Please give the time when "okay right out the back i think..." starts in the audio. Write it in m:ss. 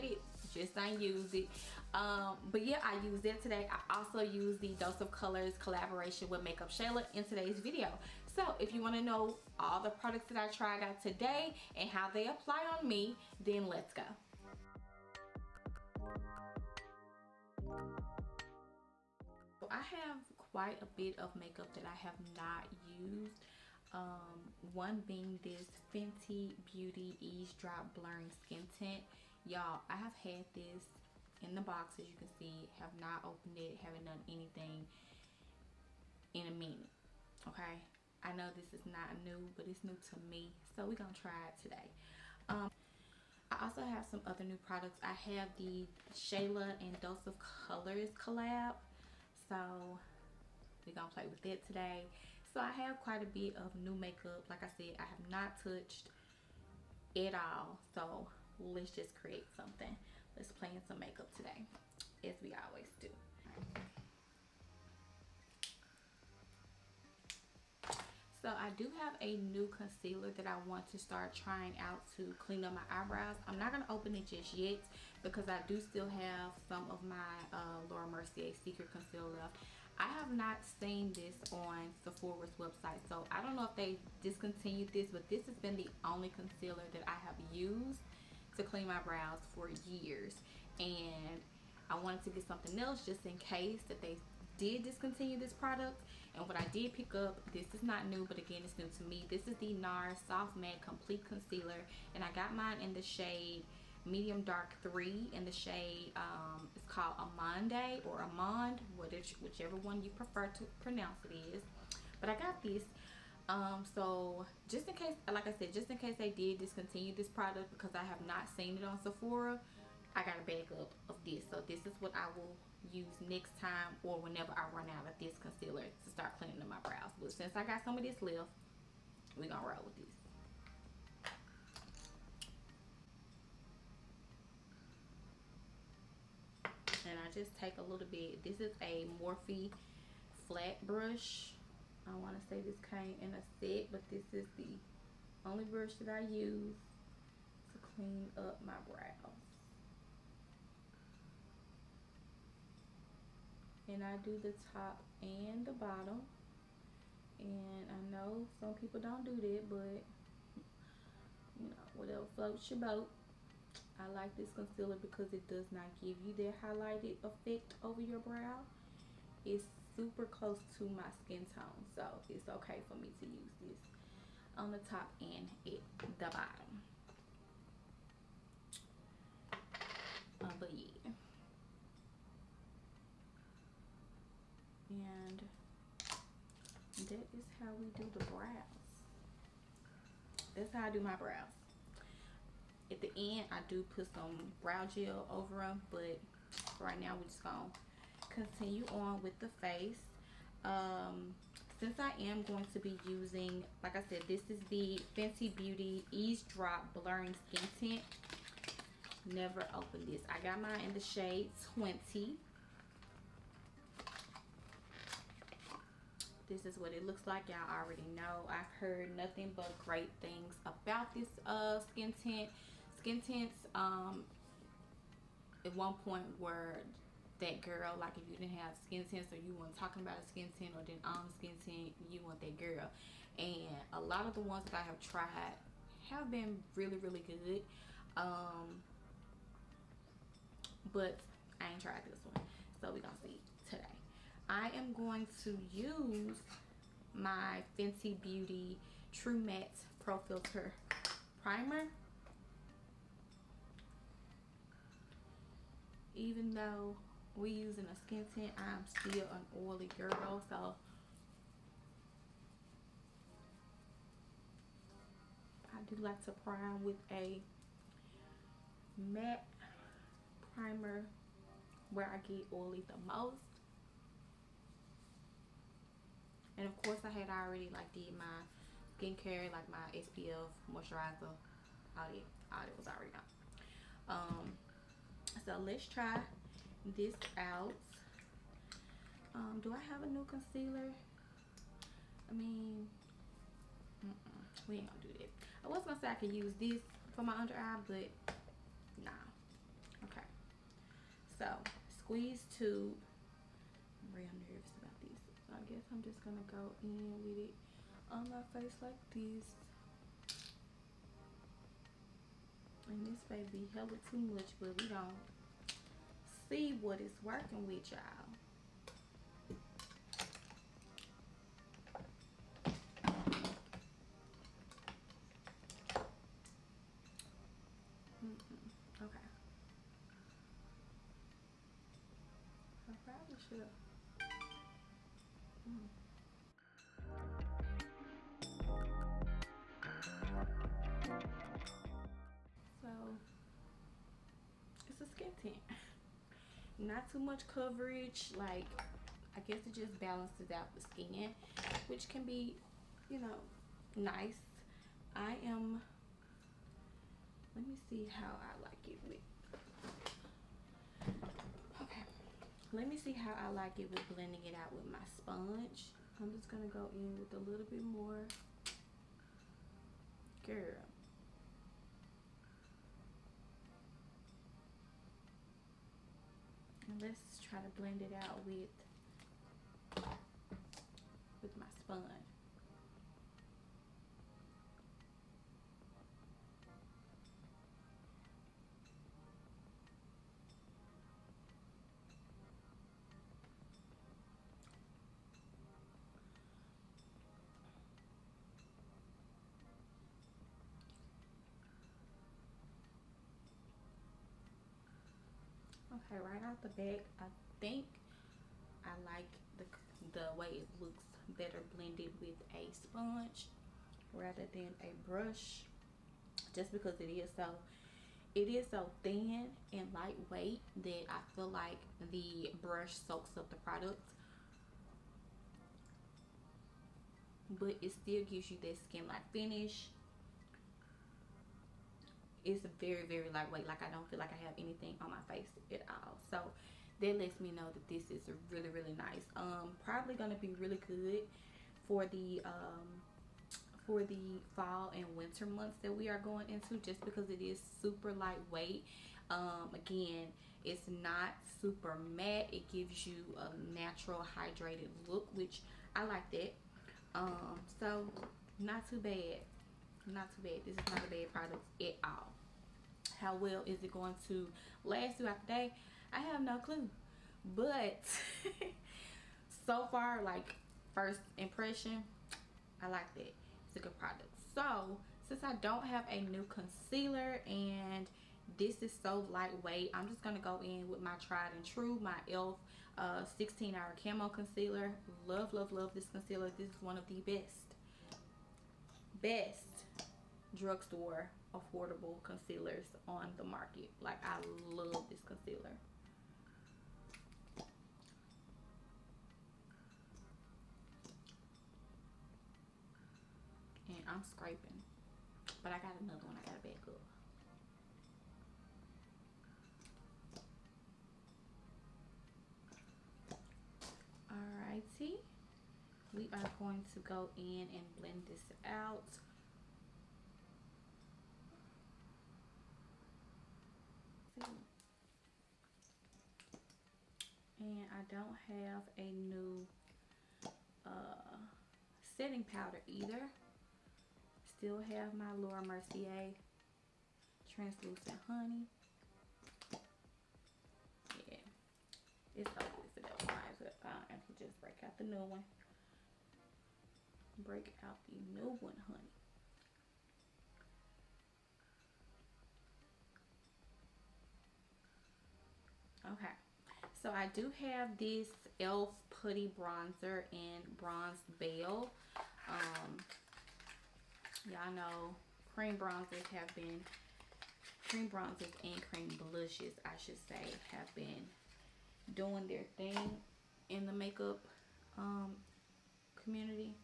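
6:46.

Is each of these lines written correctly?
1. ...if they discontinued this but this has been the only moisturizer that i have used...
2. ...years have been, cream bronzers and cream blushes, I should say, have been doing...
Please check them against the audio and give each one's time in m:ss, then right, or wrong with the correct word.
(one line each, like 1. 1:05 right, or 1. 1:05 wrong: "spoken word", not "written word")
1. 1:23 wrong: "concealer", not "moisturizer"
2. 9:25 wrong: "bronzers", not "years".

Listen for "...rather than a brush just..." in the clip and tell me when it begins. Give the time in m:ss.
6:54.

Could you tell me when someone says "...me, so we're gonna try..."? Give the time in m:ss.
0:40.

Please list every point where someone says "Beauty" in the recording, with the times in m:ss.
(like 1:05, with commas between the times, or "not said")
0:26, 3:25, 4:08.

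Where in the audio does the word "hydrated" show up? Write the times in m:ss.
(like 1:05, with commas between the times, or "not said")
7:34.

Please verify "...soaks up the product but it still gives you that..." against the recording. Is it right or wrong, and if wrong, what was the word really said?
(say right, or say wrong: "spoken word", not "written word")
right.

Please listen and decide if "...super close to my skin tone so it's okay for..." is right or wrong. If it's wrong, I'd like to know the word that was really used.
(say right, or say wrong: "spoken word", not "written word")
right.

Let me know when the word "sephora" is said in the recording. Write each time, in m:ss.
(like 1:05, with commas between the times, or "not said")
1:22, 1:58.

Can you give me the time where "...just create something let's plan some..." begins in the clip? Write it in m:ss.
0:58.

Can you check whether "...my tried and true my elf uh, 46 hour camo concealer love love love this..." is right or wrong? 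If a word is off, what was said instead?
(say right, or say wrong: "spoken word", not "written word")
wrong: "16", not "46".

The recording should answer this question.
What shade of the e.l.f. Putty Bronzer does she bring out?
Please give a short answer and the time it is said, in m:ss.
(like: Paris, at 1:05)
Bronze Belle, at 9:20.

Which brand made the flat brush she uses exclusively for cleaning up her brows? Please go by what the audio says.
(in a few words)
Morphe.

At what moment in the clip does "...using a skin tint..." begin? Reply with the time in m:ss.
4:17.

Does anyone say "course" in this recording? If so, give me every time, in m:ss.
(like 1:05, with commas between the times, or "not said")
4:36.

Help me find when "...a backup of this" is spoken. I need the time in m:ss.
2:00.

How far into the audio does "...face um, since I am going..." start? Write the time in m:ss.
3:19.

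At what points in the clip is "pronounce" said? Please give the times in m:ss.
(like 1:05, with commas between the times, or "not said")
1:50.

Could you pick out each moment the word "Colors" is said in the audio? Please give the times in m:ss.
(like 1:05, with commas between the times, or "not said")
0:05, 0:47.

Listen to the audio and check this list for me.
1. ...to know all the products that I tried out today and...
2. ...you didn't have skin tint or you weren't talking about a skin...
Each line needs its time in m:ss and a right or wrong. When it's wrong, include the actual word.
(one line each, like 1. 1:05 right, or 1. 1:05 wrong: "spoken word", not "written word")
1. 0:08 right
2. 3:48 right.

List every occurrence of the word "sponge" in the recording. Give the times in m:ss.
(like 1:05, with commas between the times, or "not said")
6:05, 6:21, 6:52.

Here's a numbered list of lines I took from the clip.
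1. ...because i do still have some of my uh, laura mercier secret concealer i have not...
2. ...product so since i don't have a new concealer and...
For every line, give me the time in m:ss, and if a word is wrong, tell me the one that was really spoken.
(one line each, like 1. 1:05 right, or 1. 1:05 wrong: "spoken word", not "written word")
1. 1:15 right
2. 7:53 right.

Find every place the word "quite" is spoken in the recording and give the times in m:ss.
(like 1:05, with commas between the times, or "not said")
0:20, 0:52.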